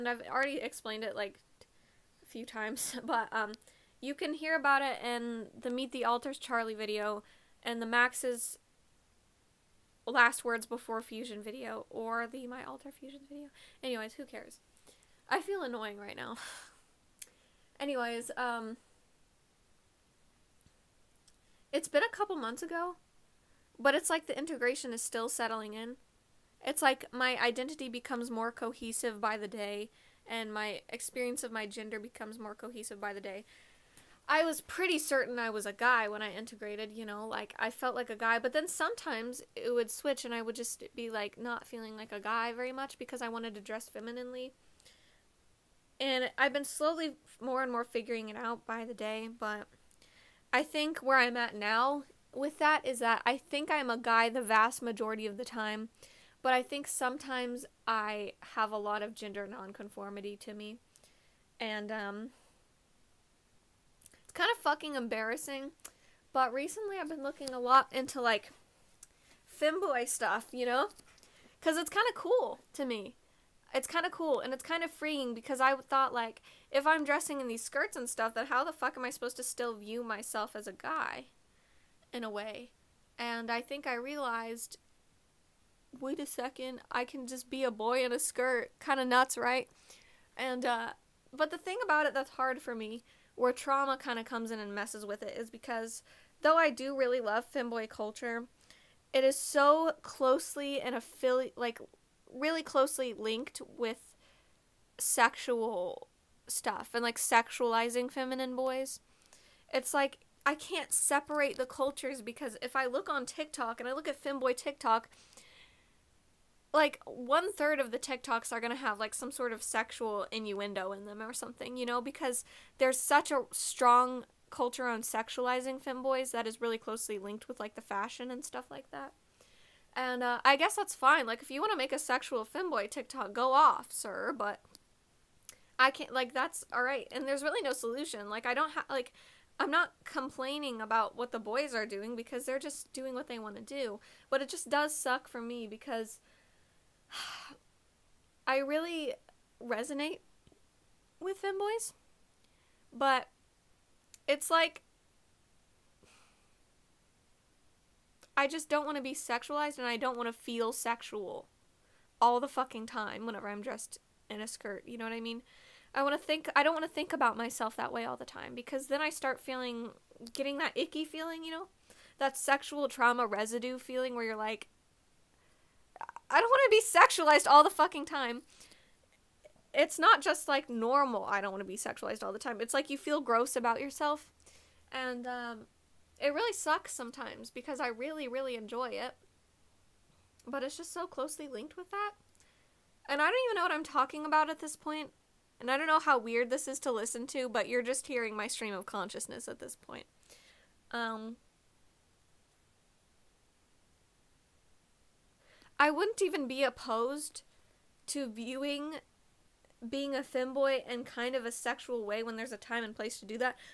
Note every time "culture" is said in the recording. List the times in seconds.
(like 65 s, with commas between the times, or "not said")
97 s, 111 s, 124 s.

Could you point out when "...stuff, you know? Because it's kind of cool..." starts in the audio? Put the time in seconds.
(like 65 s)
70 s.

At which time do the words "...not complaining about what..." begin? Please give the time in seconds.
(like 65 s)
139 s.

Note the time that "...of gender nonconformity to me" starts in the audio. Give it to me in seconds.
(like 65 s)
59 s.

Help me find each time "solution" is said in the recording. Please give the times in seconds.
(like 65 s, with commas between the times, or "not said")
137 s.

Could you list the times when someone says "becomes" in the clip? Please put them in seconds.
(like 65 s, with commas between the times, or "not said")
27 s, 31 s.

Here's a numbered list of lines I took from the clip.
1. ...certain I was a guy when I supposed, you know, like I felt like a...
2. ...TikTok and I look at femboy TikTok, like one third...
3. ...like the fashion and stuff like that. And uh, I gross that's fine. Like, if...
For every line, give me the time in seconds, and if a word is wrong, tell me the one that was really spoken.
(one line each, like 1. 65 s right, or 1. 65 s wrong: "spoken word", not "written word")
1. 34 s wrong: "integrated", not "supposed"
2. 113 s right
3. 127 s wrong: "guess", not "gross".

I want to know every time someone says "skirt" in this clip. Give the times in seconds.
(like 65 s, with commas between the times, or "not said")
77 s, 88 s, 164 s.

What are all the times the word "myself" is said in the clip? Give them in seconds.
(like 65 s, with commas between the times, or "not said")
80 s, 167 s.